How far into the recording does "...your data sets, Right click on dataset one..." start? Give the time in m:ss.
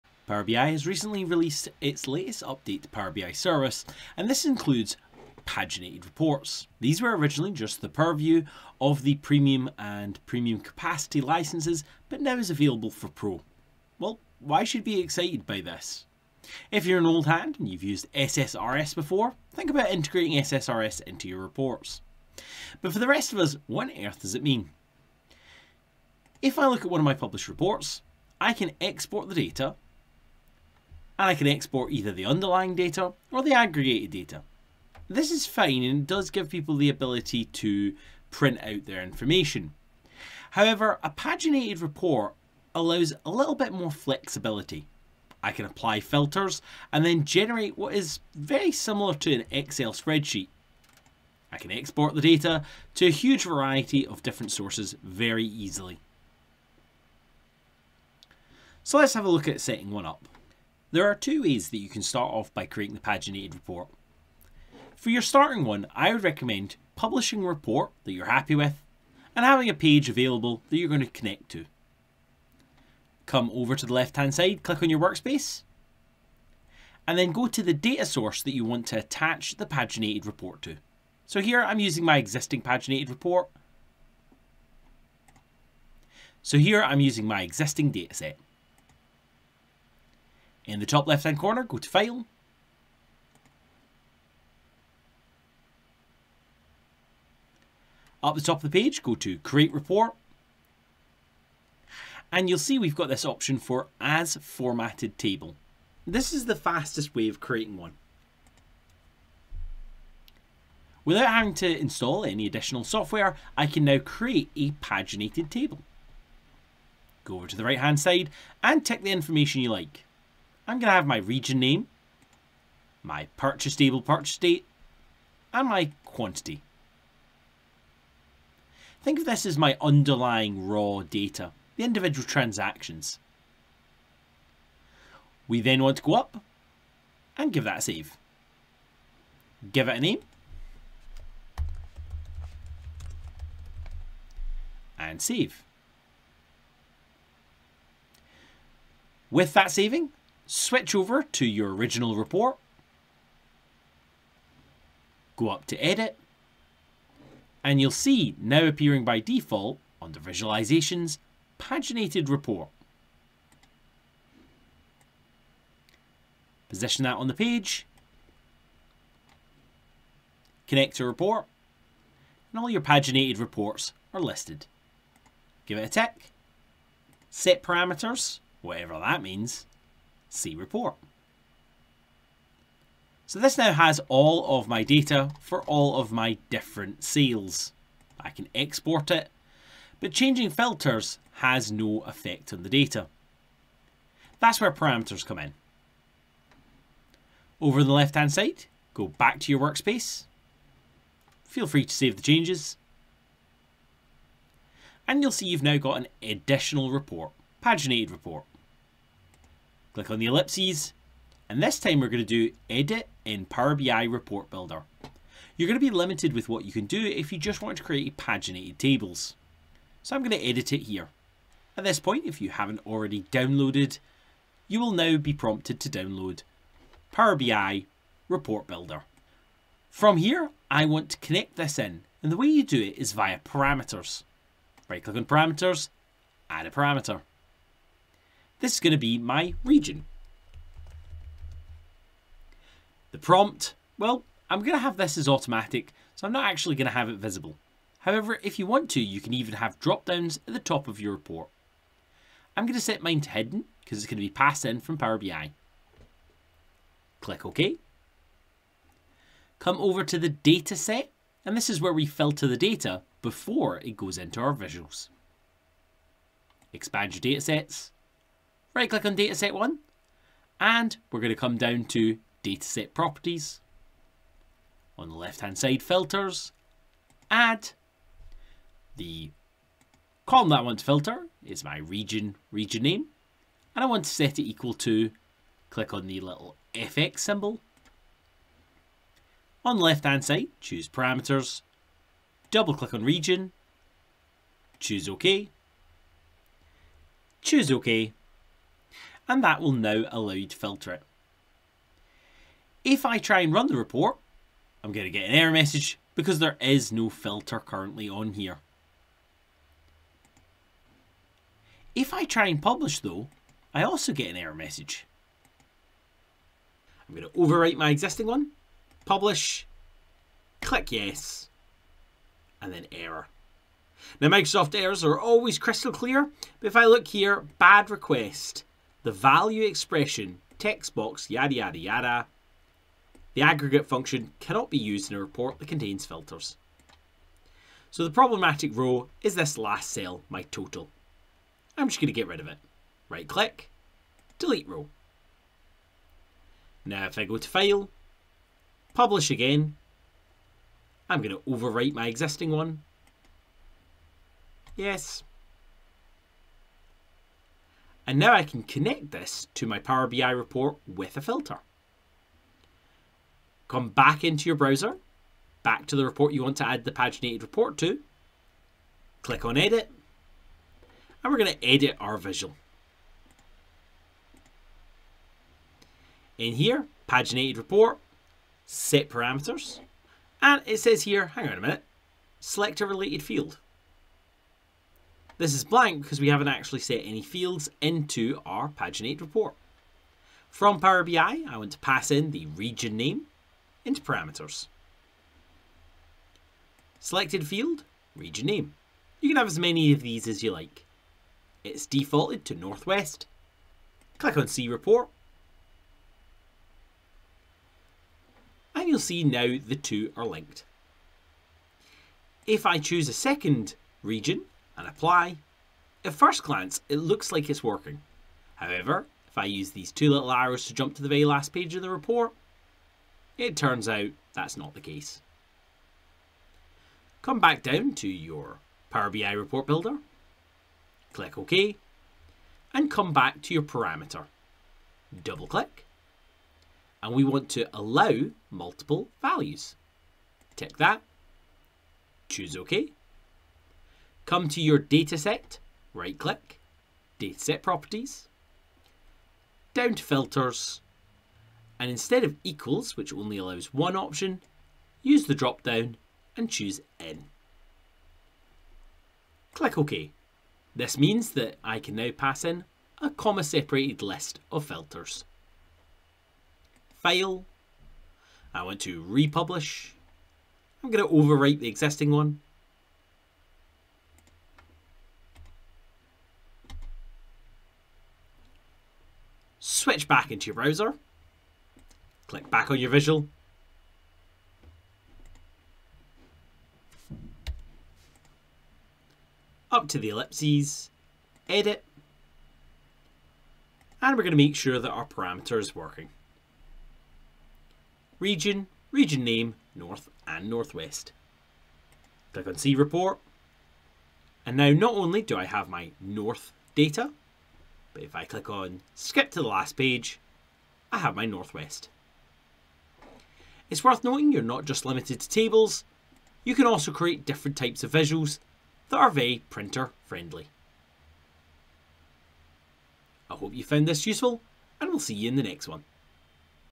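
4:27.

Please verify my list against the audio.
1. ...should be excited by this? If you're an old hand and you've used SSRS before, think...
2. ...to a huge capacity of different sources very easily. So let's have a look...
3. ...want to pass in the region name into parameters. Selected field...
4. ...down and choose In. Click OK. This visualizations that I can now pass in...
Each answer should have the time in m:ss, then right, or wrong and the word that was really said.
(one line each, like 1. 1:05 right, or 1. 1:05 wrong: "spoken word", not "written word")
1. 0:14 right
2. 0:52 wrong: "variety", not "capacity"
3. 6:31 right
4. 7:35 wrong: "means", not "visualizations".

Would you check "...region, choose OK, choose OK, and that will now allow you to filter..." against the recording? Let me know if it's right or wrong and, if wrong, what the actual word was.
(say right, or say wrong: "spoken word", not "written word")
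right.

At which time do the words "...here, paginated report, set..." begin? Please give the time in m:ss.
6:16.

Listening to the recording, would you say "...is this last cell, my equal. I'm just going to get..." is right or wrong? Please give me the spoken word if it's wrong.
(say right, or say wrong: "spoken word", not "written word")
wrong: "total", not "equal".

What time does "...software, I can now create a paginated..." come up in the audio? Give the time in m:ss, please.
1:52.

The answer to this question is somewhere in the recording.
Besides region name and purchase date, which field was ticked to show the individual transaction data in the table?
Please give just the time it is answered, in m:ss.
2:05.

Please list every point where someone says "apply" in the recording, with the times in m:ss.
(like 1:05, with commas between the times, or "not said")
0:45, 6:54.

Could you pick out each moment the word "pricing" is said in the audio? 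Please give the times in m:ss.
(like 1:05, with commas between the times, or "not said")
not said.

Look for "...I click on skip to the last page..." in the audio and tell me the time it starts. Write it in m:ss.
8:28.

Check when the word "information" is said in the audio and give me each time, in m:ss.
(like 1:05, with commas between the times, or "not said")
0:39, 1:59.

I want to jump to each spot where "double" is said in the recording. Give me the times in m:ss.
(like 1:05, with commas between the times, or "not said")
4:52, 7:15.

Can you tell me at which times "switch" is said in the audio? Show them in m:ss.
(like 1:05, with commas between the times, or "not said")
2:30, 7:59.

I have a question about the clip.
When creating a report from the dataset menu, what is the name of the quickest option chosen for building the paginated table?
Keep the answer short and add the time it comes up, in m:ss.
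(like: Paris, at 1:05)
As Formatted Table, at 1:43.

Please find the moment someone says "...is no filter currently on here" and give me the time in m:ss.
5:06.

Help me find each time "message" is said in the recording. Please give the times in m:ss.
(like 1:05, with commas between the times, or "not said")
5:05, 5:14.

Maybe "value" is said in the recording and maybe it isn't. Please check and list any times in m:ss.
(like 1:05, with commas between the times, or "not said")
5:29, 7:19.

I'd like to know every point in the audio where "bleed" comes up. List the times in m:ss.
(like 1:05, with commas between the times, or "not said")
not said.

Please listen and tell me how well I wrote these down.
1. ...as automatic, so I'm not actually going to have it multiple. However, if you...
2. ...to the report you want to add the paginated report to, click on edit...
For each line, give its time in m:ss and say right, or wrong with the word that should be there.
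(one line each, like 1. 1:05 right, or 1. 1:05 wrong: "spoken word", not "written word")
1. 4:05 wrong: "visible", not "multiple"
2. 6:05 right.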